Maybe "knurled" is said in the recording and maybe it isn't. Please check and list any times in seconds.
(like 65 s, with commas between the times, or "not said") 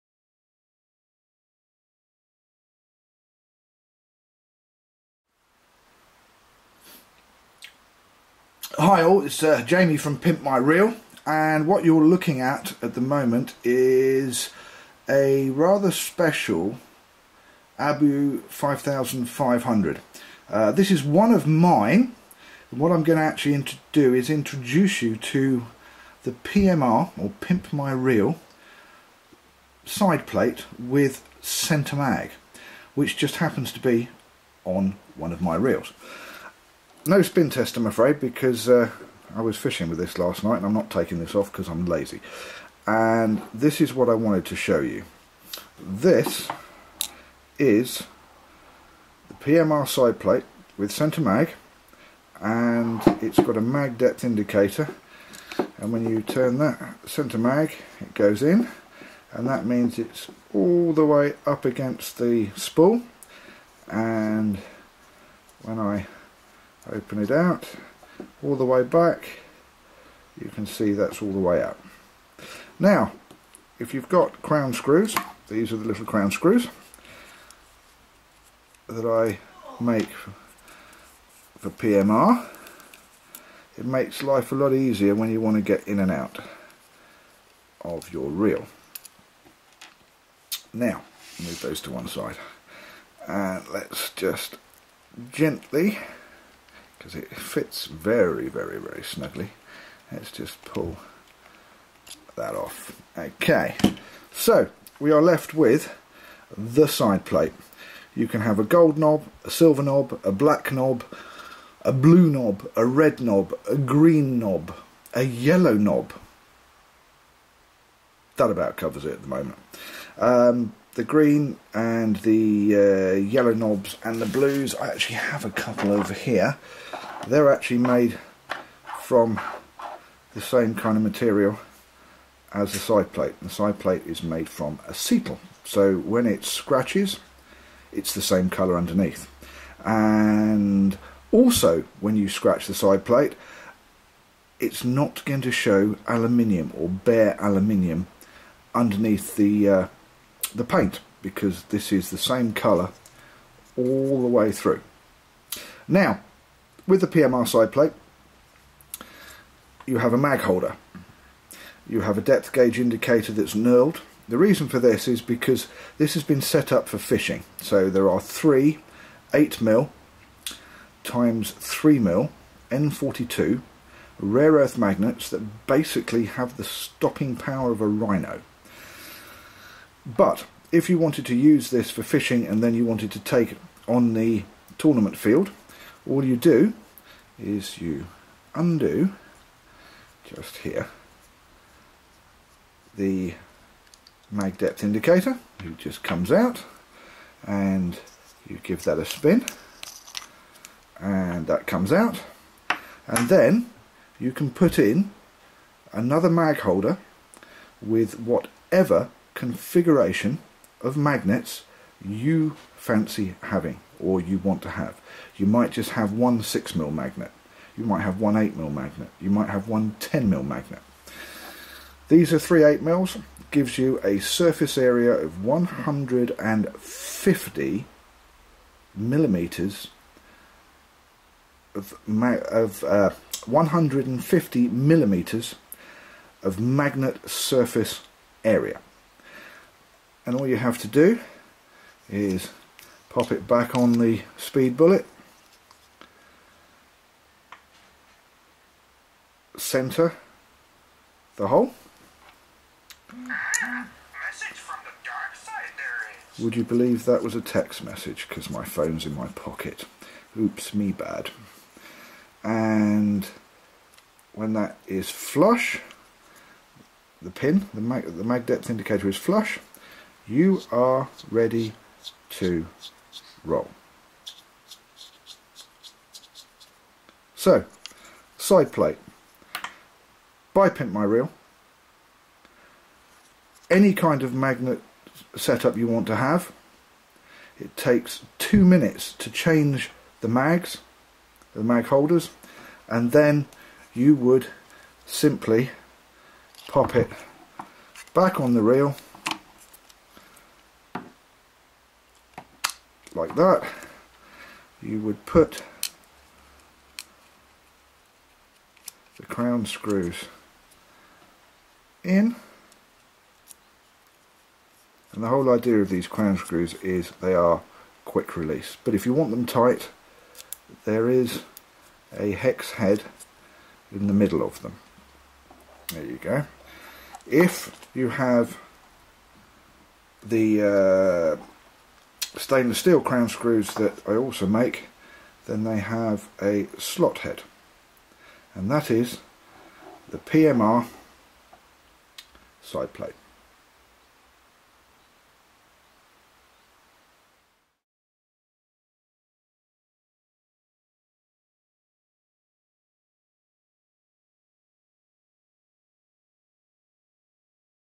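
163 s.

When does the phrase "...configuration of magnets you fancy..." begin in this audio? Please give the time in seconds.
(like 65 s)
209 s.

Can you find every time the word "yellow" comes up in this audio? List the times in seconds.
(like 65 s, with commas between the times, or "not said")
115 s, 123 s.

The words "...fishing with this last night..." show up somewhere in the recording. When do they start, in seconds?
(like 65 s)
39 s.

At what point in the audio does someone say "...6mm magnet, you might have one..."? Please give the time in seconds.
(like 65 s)
216 s.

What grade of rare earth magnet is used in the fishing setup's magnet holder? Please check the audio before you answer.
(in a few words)
N42.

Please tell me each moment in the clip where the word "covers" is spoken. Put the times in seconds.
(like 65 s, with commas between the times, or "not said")
118 s.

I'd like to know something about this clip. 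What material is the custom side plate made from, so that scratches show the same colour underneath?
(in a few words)
Acetyl.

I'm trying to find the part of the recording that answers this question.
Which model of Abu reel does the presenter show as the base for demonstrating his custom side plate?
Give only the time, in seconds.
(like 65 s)
18 s.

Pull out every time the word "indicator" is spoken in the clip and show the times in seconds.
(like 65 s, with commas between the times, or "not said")
54 s, 162 s, 194 s, 268 s.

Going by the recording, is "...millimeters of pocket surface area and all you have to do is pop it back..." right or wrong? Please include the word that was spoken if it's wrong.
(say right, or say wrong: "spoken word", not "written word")
wrong: "magnet", not "pocket".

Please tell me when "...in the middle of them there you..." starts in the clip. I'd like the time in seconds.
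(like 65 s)
323 s.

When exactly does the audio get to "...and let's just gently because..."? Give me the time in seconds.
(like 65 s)
93 s.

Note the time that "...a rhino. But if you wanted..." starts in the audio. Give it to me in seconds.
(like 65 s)
177 s.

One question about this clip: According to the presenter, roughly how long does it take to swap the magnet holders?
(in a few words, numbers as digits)
2 minutes.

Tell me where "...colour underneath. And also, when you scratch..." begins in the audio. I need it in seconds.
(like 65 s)
138 s.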